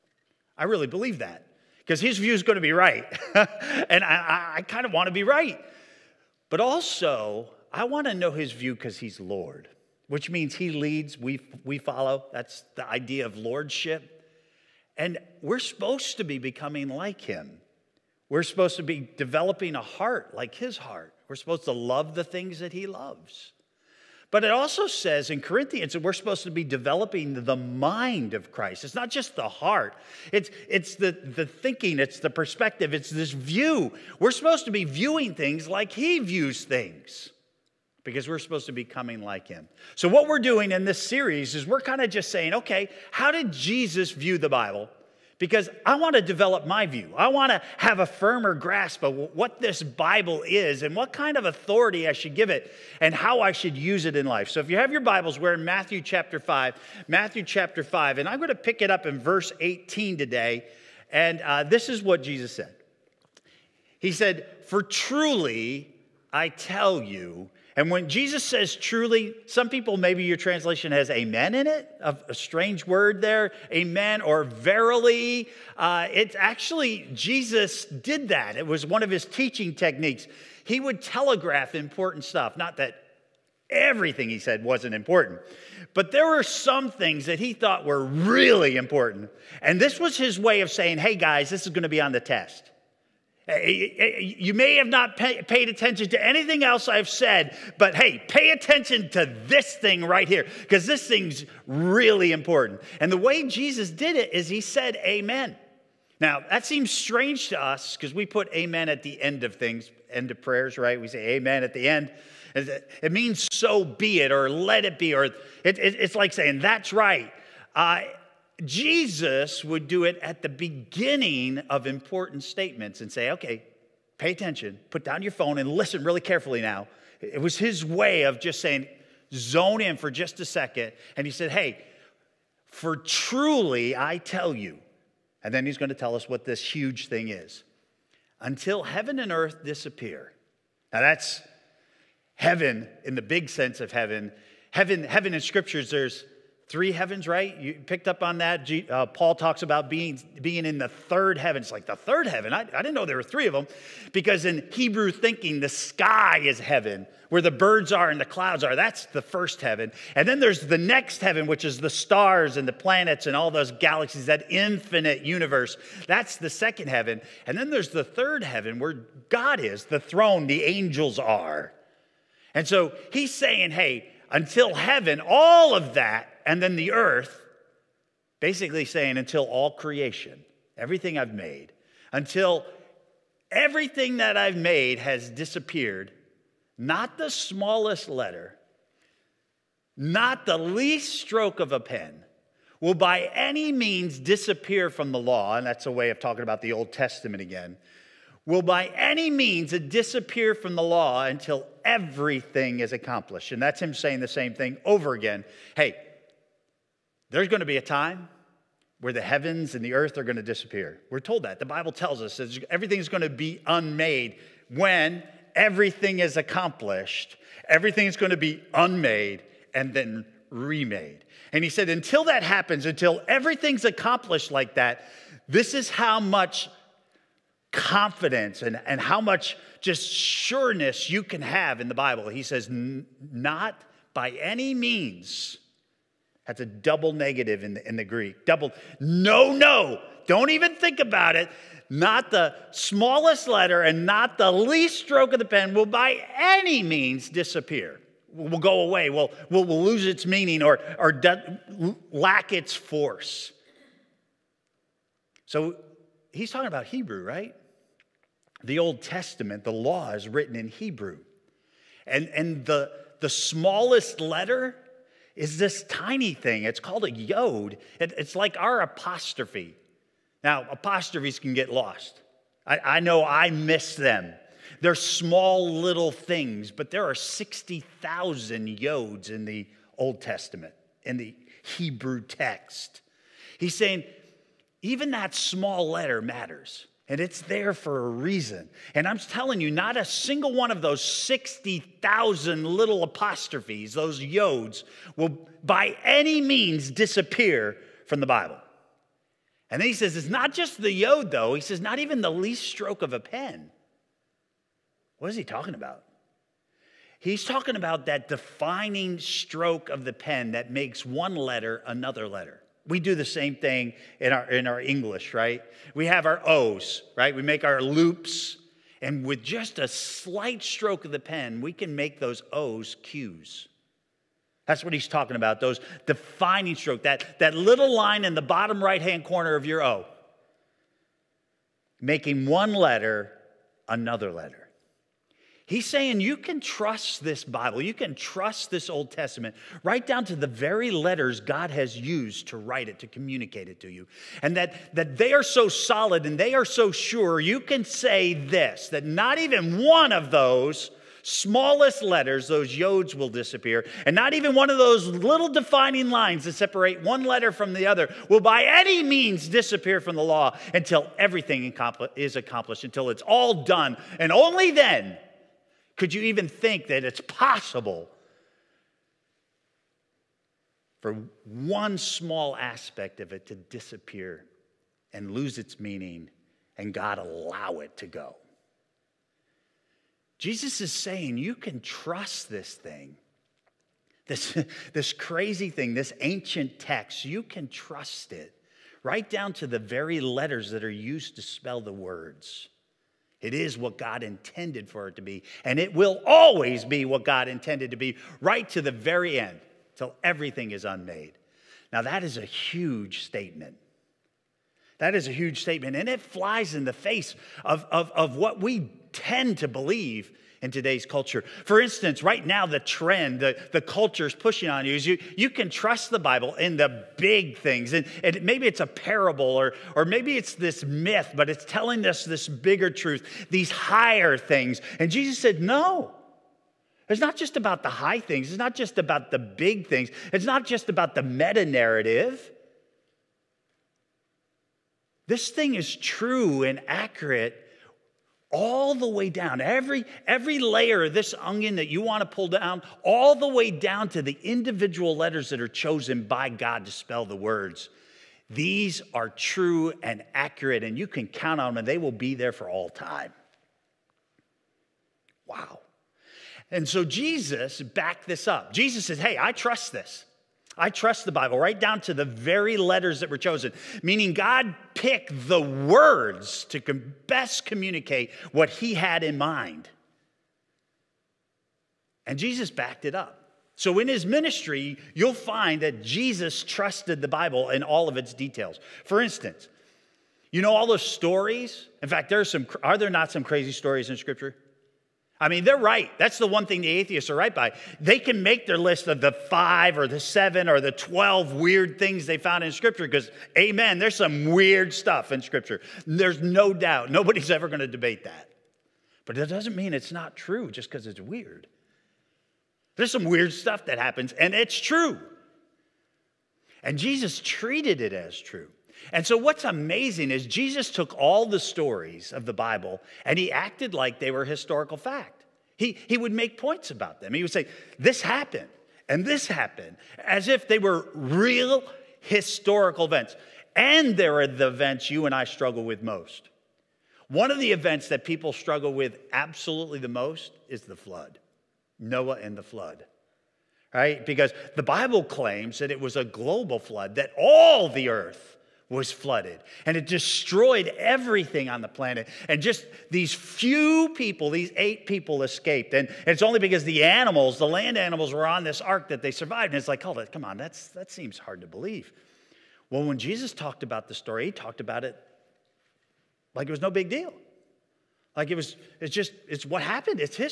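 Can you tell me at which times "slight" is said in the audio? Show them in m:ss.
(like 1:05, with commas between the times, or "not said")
5:19.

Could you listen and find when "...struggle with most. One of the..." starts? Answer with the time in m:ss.
8:45.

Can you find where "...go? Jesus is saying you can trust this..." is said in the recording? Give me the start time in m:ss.
6:18.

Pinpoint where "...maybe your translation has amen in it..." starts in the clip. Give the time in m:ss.
1:09.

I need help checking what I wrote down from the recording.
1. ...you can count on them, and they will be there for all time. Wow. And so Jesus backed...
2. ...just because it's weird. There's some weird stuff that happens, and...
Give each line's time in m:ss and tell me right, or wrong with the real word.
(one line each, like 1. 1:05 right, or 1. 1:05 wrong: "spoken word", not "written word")
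1. 7:30 right
2. 8:20 right.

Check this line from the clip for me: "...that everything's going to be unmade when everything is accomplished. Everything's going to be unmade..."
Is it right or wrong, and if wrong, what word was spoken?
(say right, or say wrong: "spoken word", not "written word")
right.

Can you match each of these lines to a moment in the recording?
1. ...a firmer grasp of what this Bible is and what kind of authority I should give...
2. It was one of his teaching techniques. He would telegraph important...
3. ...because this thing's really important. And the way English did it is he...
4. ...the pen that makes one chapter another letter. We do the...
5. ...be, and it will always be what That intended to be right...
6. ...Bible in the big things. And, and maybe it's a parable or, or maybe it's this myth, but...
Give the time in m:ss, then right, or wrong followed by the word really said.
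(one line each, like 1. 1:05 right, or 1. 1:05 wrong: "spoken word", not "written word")
1. 0:47 right
2. 1:18 right
3. 1:40 wrong: "Jesus", not "English"
4. 5:10 wrong: "letter", not "chapter"
5. 6:35 wrong: "God", not "That"
6. 6:56 right.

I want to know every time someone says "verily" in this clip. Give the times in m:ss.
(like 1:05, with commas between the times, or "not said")
1:14.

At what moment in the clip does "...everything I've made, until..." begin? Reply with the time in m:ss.
3:00.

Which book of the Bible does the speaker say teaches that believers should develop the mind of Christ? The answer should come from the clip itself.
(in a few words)
Corinthians.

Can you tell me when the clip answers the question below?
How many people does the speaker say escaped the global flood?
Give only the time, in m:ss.
9:04.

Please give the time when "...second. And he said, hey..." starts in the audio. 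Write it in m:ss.
2:10.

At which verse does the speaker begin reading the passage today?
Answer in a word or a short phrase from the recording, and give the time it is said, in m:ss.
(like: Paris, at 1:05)
18, at 0:59.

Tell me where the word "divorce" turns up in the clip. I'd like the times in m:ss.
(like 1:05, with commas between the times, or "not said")
not said.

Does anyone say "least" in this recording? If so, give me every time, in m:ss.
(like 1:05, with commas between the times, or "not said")
3:10, 4:04, 5:02.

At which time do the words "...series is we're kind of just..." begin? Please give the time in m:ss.
0:41.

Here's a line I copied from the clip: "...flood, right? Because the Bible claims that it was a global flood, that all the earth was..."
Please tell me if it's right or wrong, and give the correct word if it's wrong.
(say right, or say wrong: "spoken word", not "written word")
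right.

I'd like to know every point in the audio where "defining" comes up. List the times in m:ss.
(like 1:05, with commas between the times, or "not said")
5:08, 5:26, 5:55.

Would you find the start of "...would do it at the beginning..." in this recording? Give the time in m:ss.
1:59.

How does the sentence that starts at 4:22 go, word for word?
And, and the, the smallest letter is this tiny thing.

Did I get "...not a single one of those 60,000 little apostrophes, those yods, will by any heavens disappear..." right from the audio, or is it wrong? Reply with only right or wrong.
wrong.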